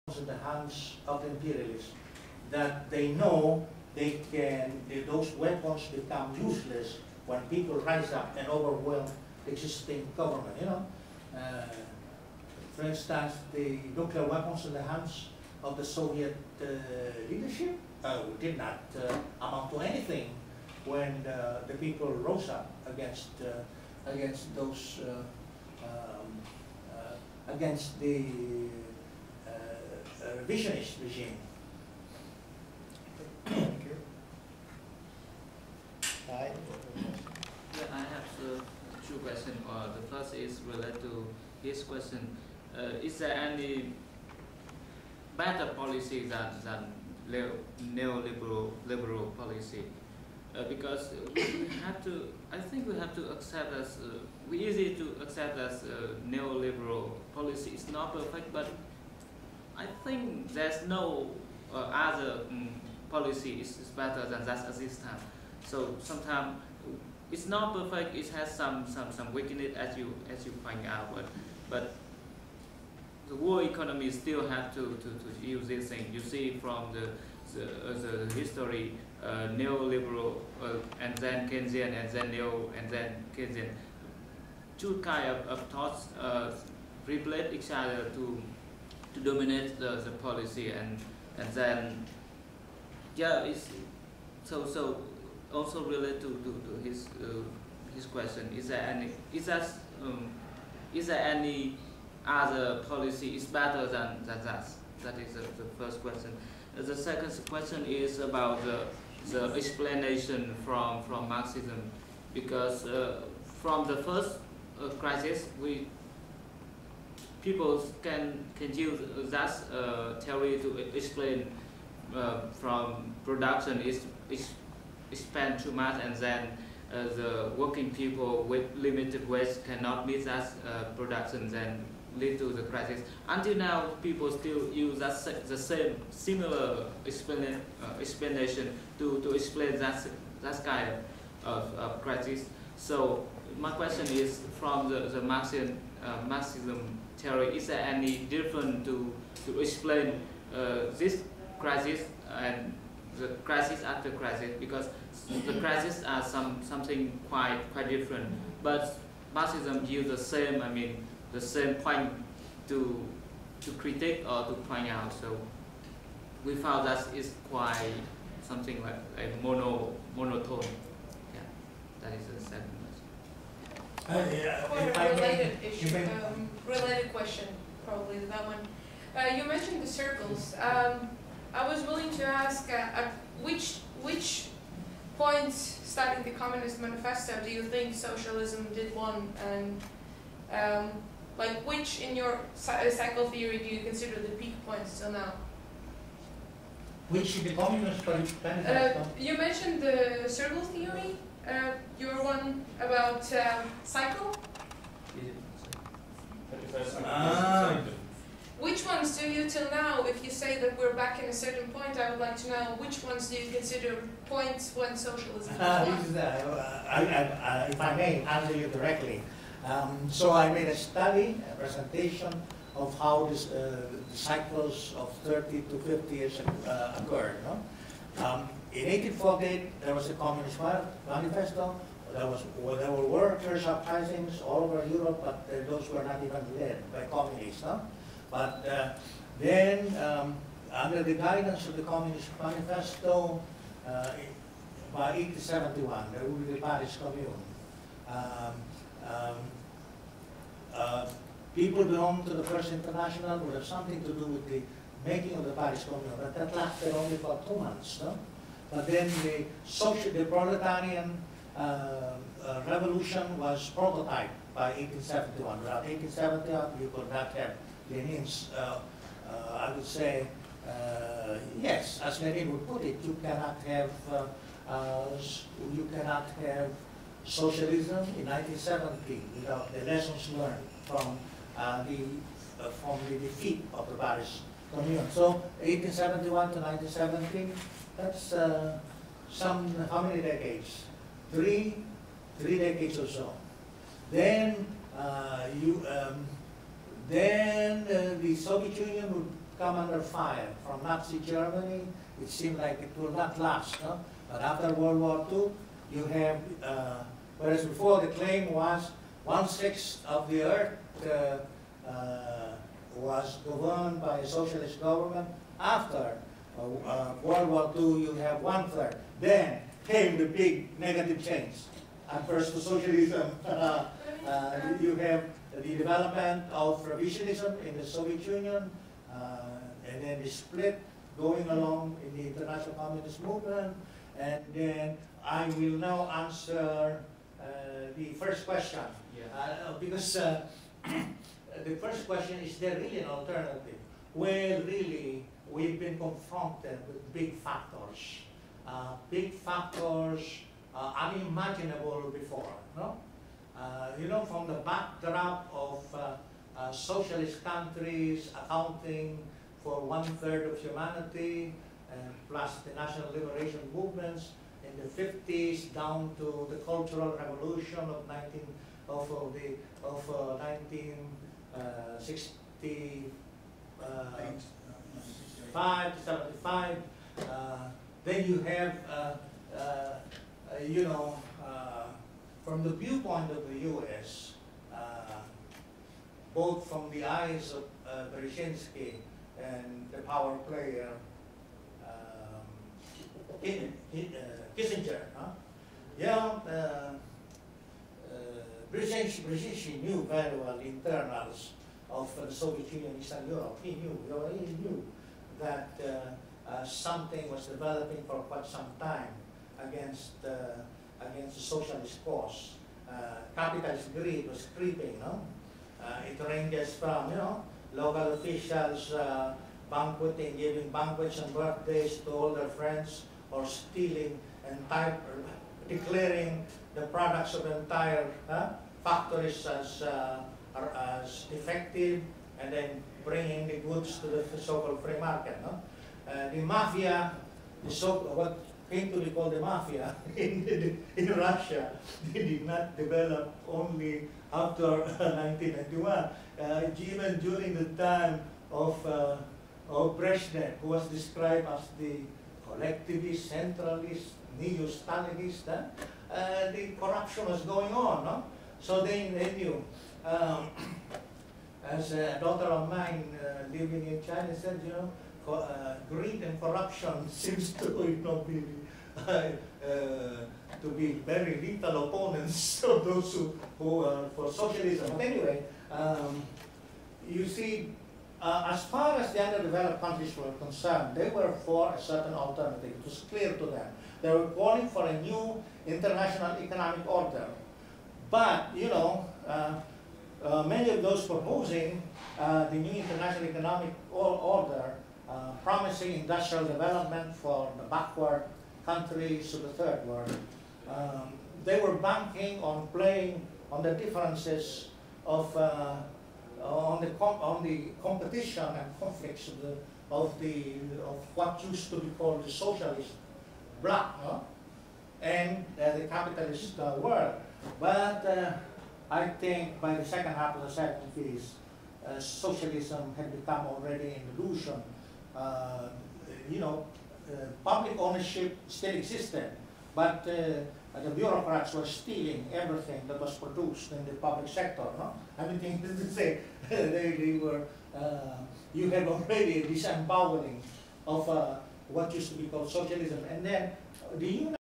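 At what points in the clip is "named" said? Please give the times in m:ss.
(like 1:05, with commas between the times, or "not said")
not said.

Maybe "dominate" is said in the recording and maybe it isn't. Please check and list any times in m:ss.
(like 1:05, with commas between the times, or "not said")
1:29.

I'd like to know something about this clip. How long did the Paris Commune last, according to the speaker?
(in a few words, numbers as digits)
two months.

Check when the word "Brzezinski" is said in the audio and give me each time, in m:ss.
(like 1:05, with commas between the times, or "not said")
6:28, 6:39.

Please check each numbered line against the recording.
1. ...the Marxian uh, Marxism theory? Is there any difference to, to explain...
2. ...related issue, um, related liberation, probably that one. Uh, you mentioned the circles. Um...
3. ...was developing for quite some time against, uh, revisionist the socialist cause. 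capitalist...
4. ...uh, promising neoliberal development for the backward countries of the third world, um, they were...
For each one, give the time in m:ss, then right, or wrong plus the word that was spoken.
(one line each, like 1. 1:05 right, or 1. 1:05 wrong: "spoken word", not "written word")
1. 2:25 right
2. 2:55 wrong: "question", not "liberation"
3. 6:47 wrong: "against", not "revisionist"
4. 8:15 wrong: "industrial", not "neoliberal".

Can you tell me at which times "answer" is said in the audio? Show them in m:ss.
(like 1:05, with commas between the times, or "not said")
3:38, 5:36.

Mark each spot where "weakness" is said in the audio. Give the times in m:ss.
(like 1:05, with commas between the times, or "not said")
1:09.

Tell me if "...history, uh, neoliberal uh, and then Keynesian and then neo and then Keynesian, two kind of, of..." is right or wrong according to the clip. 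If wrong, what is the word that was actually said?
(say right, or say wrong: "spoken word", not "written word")
right.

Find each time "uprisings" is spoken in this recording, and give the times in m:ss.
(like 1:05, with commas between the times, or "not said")
3:53.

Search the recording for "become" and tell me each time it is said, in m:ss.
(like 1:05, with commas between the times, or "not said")
0:05, 8:43.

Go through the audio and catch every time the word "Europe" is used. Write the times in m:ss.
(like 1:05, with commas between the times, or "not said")
3:54, 6:43.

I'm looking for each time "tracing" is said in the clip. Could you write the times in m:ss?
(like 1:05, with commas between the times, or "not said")
not said.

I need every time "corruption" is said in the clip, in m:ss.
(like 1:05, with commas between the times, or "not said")
7:36, 7:46.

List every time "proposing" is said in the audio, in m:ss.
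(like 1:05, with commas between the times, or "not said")
8:11.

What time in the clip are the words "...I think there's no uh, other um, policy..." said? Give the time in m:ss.
0:59.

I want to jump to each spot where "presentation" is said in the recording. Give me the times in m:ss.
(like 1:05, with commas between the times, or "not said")
3:41.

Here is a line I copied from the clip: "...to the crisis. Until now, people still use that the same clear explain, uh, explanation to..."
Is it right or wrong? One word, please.
wrong.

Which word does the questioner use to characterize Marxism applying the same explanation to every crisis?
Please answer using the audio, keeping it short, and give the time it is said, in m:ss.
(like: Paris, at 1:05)
monotone, at 2:50.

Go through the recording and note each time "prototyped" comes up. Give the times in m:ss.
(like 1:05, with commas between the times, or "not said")
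4:23.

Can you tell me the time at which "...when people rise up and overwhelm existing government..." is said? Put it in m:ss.
0:07.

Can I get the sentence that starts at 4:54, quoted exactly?
Then uh, you, um, then uh, the Soviet Union would come under fire from Nazi Germany.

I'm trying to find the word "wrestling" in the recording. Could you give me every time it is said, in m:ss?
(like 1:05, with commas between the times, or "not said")
not said.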